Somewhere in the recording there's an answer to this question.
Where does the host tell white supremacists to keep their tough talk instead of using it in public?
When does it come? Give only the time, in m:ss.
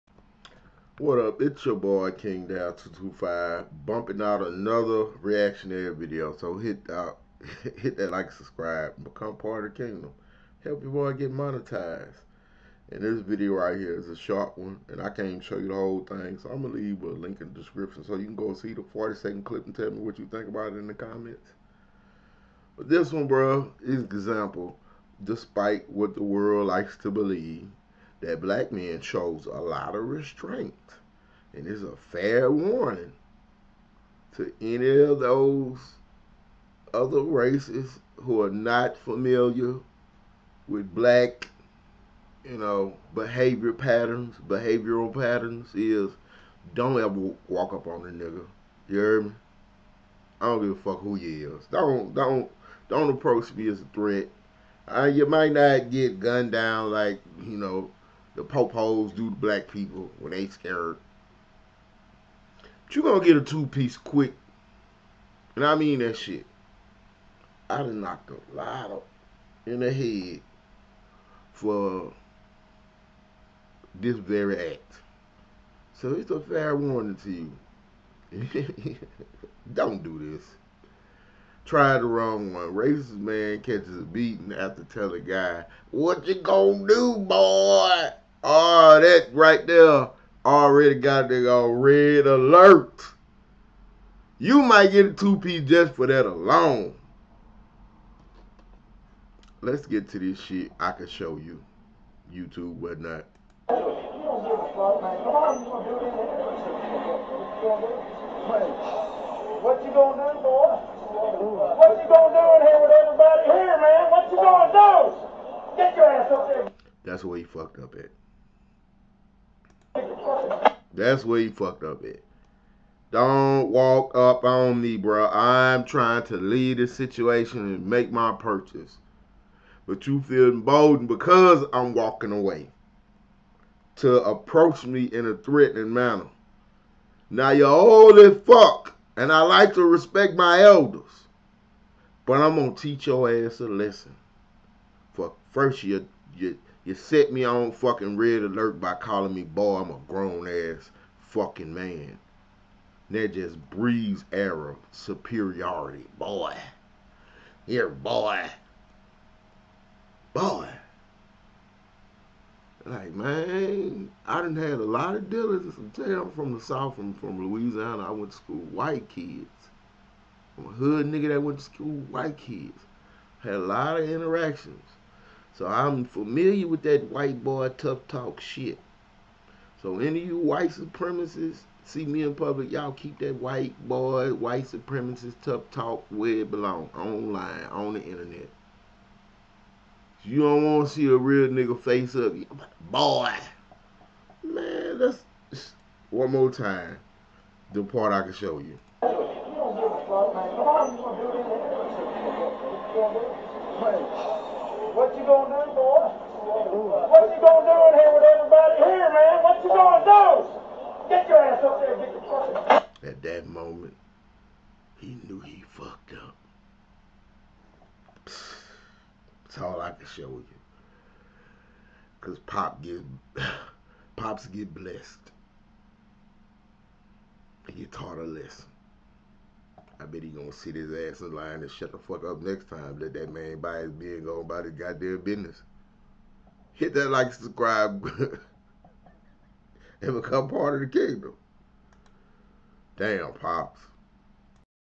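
3:06.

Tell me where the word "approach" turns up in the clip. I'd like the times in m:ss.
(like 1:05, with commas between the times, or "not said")
0:53, 2:14.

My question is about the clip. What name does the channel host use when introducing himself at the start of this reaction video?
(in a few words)
King Dal 225.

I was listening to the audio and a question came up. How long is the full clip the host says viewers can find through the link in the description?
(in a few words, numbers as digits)
40 seconds.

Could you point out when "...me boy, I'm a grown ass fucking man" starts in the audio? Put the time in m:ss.
2:29.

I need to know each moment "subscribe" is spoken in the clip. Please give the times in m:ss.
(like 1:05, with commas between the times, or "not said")
0:08, 3:57.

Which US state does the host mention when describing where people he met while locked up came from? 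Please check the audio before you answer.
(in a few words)
Louisiana.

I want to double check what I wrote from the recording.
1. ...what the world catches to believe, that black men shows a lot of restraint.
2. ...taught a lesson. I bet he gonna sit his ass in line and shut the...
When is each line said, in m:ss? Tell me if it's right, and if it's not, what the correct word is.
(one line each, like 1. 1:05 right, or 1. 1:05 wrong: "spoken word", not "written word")
1. 0:25 wrong: "likes", not "catches"
2. 3:47 right.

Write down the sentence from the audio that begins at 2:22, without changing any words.
But I'm gonna teach your ass a lesson.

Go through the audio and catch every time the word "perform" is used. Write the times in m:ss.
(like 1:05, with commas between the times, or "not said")
not said.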